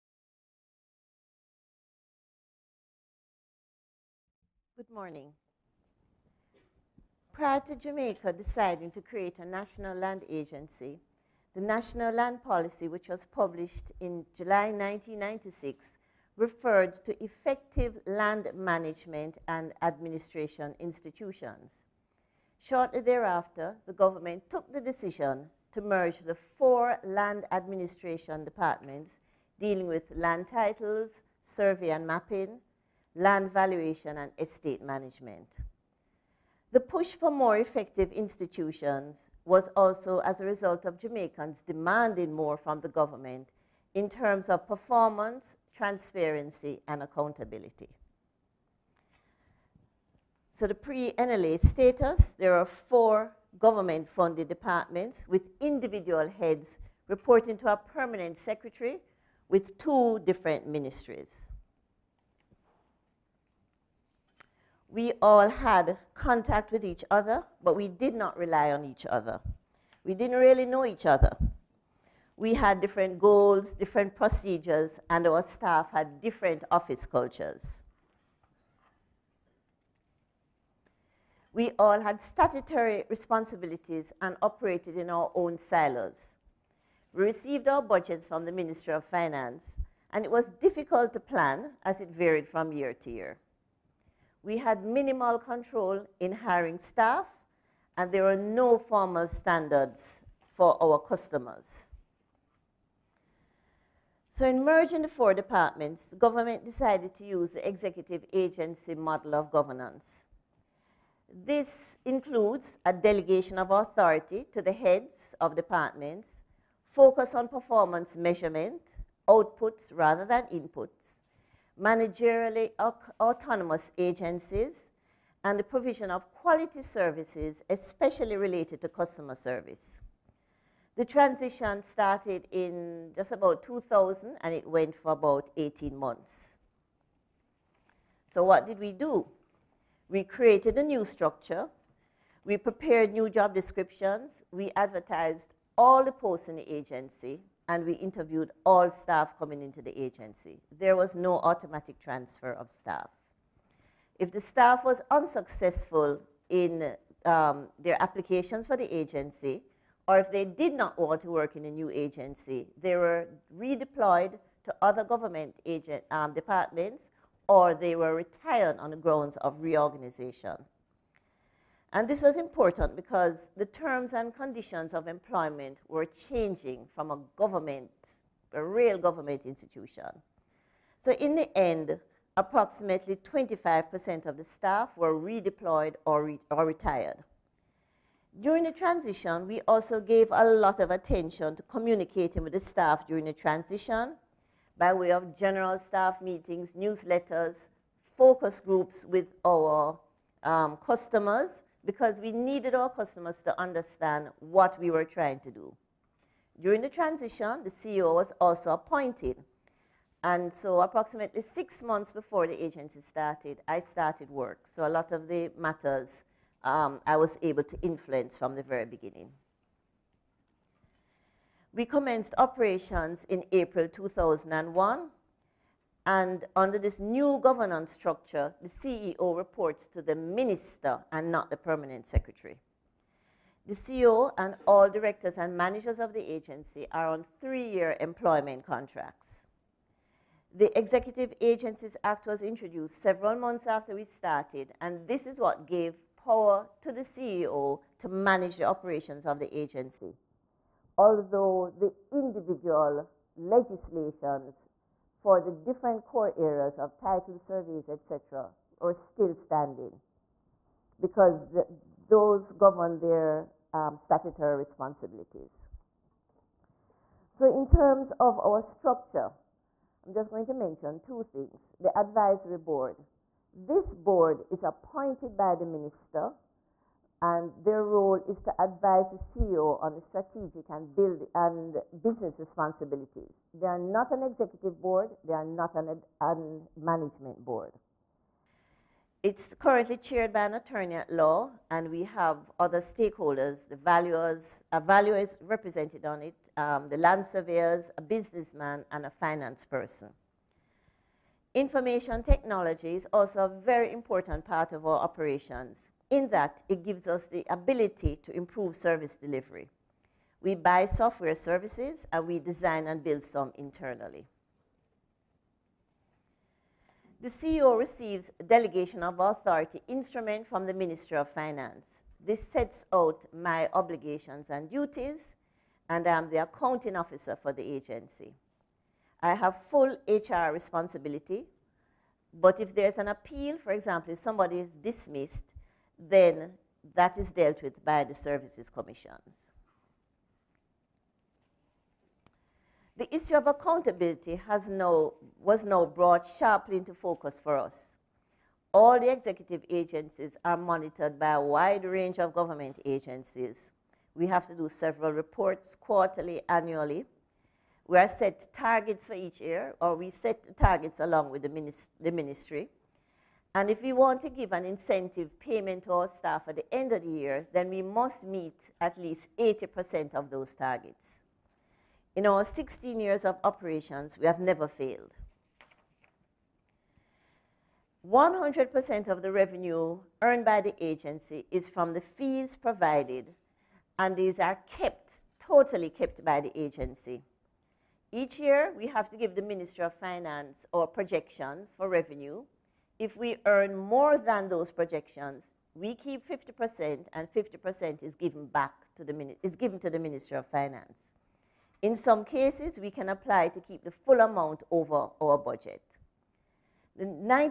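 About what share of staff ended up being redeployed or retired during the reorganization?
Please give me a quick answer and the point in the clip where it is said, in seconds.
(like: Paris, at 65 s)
25%, at 183 s.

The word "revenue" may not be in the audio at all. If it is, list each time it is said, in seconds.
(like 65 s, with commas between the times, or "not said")
379 s, 391 s.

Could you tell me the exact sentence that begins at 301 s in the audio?
Information technology is also a very important part of our operations.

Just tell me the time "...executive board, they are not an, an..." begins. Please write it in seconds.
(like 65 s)
284 s.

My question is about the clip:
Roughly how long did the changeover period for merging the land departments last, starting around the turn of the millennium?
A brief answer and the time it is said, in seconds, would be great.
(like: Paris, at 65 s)
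18 months, at 135 s.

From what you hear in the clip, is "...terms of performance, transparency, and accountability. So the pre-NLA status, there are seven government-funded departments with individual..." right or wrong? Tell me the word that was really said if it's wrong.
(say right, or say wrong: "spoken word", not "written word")
wrong: "four", not "seven".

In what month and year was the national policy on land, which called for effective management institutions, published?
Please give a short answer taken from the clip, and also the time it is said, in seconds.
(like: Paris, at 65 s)
July 1996, at 14 s.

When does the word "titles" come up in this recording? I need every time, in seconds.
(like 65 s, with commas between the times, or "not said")
30 s, 256 s.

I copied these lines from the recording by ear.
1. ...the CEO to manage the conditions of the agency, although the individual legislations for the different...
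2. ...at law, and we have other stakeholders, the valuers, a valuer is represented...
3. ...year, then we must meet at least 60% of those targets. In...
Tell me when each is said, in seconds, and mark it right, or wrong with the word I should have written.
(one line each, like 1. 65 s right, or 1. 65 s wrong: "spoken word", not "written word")
1. 246 s wrong: "operations", not "conditions"
2. 290 s right
3. 367 s wrong: "80", not "60".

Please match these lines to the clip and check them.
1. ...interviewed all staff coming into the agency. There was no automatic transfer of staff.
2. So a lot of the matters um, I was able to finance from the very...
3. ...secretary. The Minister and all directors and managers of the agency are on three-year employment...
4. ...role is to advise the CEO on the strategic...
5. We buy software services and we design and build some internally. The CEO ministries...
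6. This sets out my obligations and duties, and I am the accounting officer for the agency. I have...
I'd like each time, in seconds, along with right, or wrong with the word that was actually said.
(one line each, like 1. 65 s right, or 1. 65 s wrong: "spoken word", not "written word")
1. 147 s right
2. 214 s wrong: "influence", not "finance"
3. 232 s wrong: "CEO", not "Minister"
4. 277 s right
5. 310 s wrong: "receives", not "ministries"
6. 322 s right.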